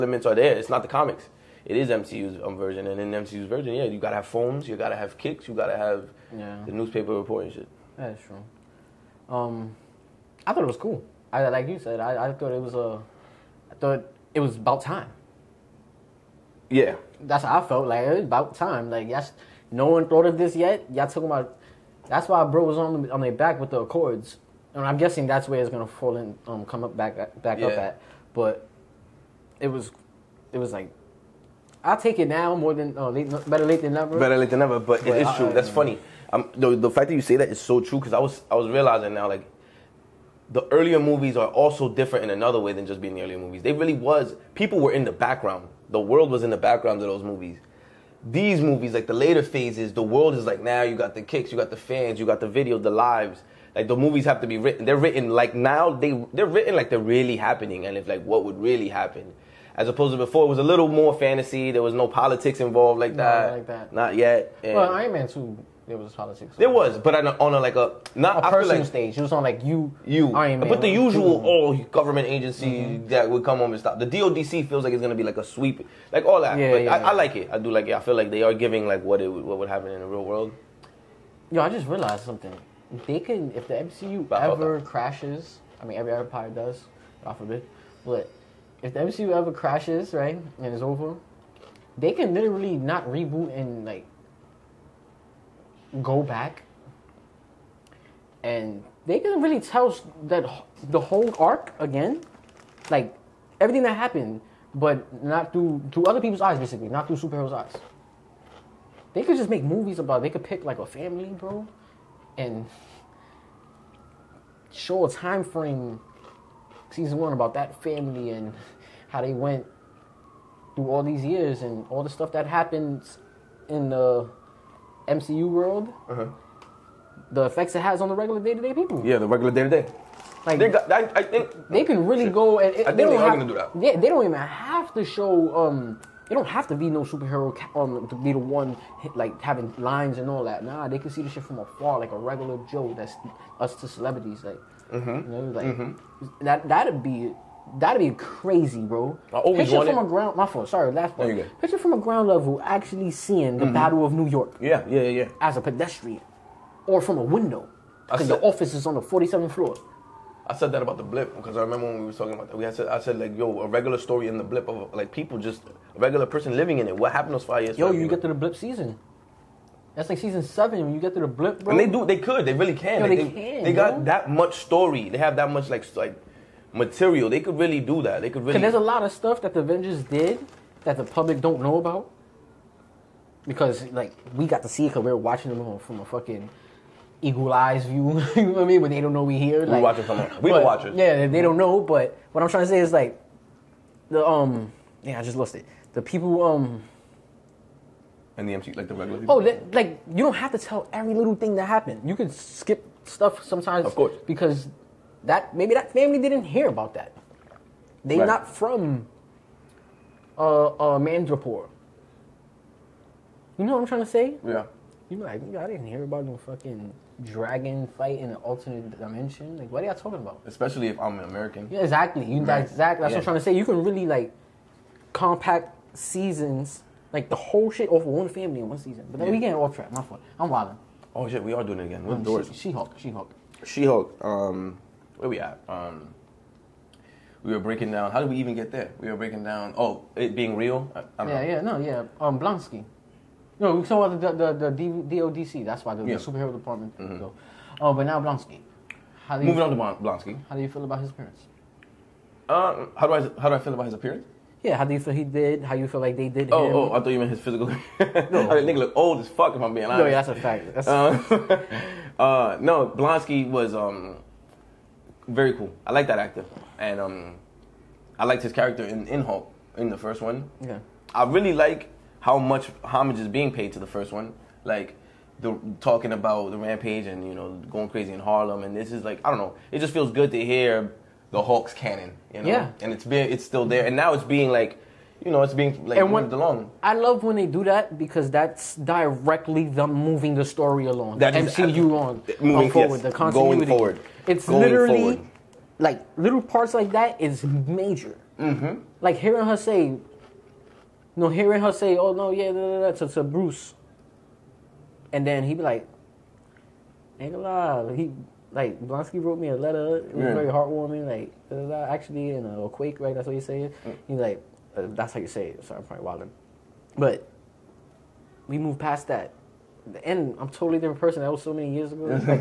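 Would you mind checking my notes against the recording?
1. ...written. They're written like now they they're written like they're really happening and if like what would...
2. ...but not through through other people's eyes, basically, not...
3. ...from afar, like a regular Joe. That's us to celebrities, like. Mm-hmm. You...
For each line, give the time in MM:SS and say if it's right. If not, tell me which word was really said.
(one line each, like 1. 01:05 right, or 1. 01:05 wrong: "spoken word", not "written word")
1. 00:54 right
2. 01:44 right
3. 02:21 right.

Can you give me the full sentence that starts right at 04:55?
like little parts like that is major.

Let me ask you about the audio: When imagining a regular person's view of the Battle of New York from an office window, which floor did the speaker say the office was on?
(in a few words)
47th floor.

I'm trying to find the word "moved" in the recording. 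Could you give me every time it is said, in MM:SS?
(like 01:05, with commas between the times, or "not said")
04:46, 05:18.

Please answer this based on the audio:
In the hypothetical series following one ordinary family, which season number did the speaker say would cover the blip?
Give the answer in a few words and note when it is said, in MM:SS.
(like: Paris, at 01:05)
Season 7, at 02:50.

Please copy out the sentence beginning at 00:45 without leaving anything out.
The world was in the background of those movies.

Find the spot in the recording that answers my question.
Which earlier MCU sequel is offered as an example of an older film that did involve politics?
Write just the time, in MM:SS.
01:04.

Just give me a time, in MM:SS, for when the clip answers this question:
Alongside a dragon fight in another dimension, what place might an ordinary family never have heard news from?
03:30.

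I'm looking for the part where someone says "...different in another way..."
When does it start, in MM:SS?
00:41.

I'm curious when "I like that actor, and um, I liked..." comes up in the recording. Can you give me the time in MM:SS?
04:25.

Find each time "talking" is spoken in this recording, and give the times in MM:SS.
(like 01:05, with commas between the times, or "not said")
00:21, 02:42, 03:39, 04:35.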